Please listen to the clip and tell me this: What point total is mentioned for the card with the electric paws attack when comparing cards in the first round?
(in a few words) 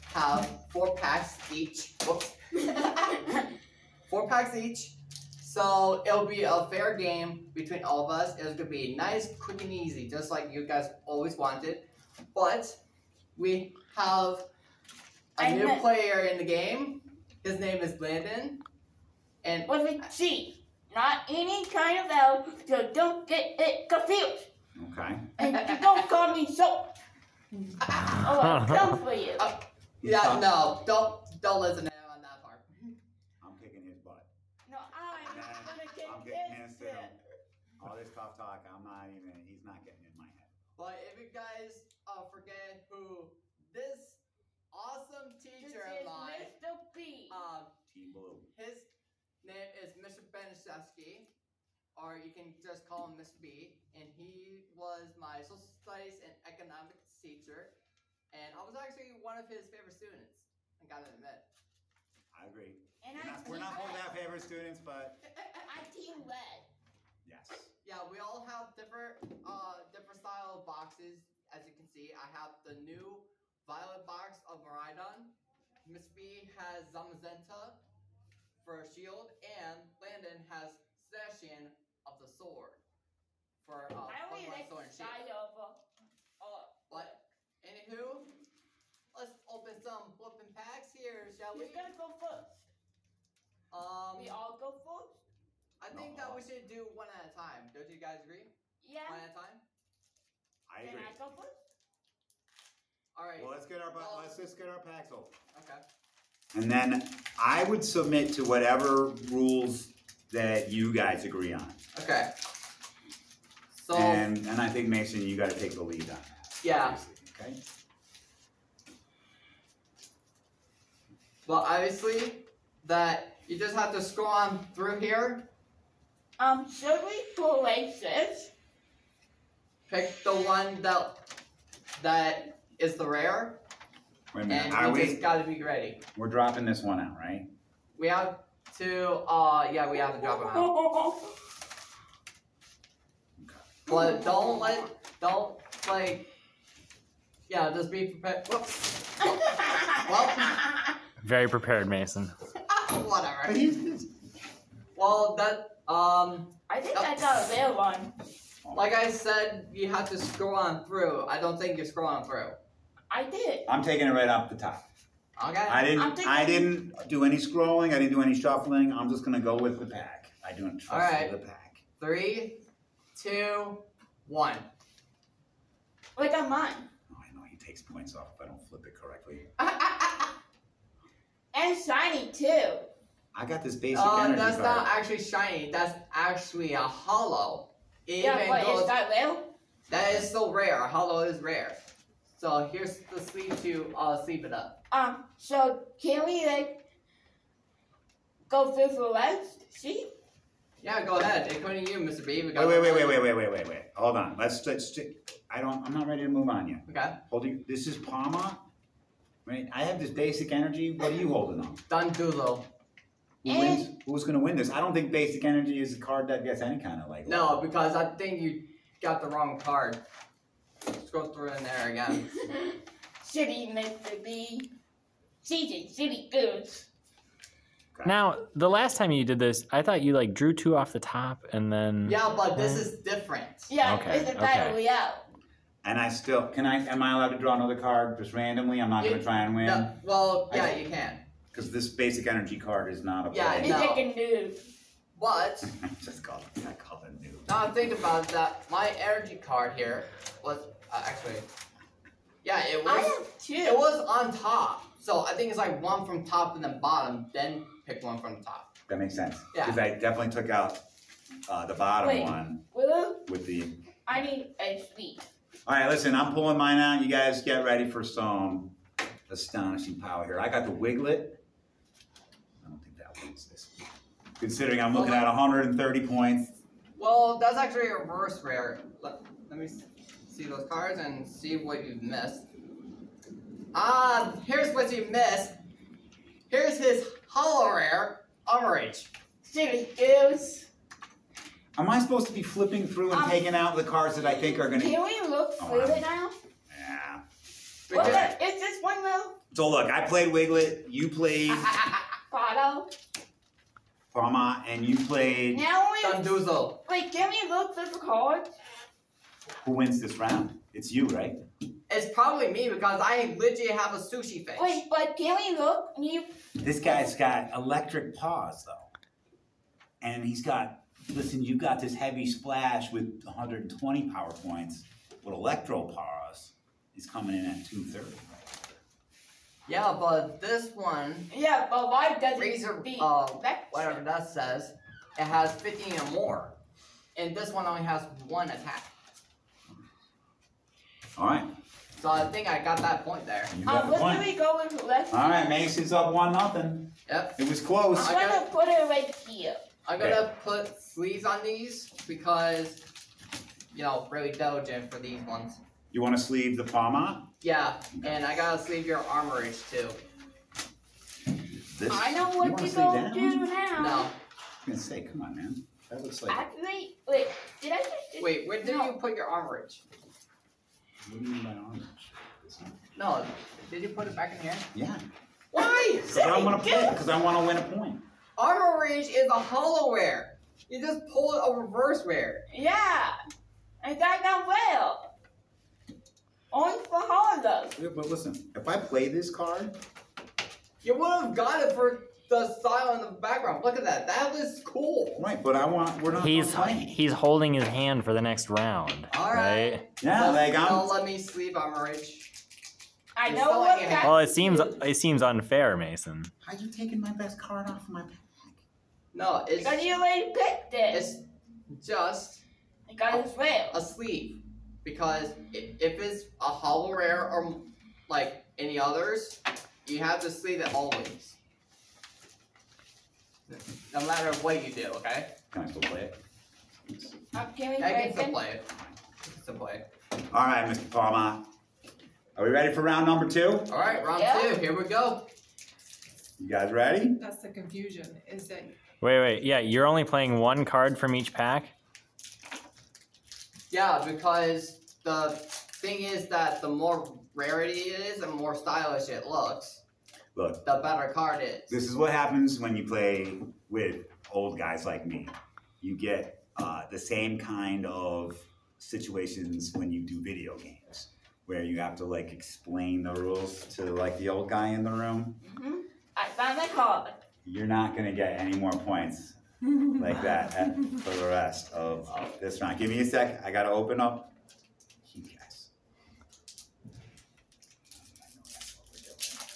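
230.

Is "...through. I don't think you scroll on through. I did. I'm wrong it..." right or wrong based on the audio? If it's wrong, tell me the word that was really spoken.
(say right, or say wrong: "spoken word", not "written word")
wrong: "taking", not "wrong".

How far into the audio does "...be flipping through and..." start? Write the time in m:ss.
4:52.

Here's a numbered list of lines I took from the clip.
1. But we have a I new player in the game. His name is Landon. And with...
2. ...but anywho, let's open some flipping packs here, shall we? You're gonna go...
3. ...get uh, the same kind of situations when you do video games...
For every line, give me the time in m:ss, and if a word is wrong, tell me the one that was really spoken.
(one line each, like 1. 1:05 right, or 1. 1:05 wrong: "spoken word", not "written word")
1. 0:12 right
2. 1:26 right
3. 7:35 right.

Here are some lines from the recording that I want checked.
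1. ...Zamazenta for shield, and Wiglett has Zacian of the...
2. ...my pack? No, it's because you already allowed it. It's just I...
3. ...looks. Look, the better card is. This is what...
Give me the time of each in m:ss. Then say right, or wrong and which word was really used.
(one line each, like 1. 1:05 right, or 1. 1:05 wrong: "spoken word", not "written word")
1. 1:16 wrong: "Landon", not "Wiglett"
2. 6:47 wrong: "picked", not "allowed"
3. 7:29 right.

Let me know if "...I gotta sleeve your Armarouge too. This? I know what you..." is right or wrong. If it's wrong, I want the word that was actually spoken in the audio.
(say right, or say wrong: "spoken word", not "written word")
right.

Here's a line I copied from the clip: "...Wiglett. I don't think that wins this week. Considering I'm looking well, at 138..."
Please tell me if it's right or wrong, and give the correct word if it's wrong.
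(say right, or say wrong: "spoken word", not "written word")
wrong: "130", not "138".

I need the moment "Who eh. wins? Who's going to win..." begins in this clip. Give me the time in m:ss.
3:33.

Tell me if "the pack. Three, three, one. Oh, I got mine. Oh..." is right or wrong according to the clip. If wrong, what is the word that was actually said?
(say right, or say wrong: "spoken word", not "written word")
wrong: "two", not "three".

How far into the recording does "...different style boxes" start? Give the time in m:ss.
1:09.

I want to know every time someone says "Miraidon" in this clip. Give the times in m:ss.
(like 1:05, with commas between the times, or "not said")
1:14.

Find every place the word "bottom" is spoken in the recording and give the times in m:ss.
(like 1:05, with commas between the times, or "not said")
4:16, 4:21.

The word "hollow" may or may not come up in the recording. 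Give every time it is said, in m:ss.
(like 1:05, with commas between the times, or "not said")
3:06, 3:10, 4:47, 6:19, 6:56.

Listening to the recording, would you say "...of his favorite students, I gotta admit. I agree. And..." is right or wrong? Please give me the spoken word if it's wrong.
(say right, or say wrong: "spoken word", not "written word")
right.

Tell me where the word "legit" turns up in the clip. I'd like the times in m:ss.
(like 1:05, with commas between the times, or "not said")
5:13.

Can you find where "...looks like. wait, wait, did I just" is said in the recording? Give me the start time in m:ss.
6:06.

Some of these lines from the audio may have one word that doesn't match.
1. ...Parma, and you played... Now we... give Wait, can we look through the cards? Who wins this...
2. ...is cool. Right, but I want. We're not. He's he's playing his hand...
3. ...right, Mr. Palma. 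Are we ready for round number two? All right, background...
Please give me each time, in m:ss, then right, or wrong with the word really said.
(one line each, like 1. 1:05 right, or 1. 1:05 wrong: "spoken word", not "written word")
1. 5:04 right
2. 6:34 wrong: "holding", not "playing"
3. 7:10 wrong: "round", not "background".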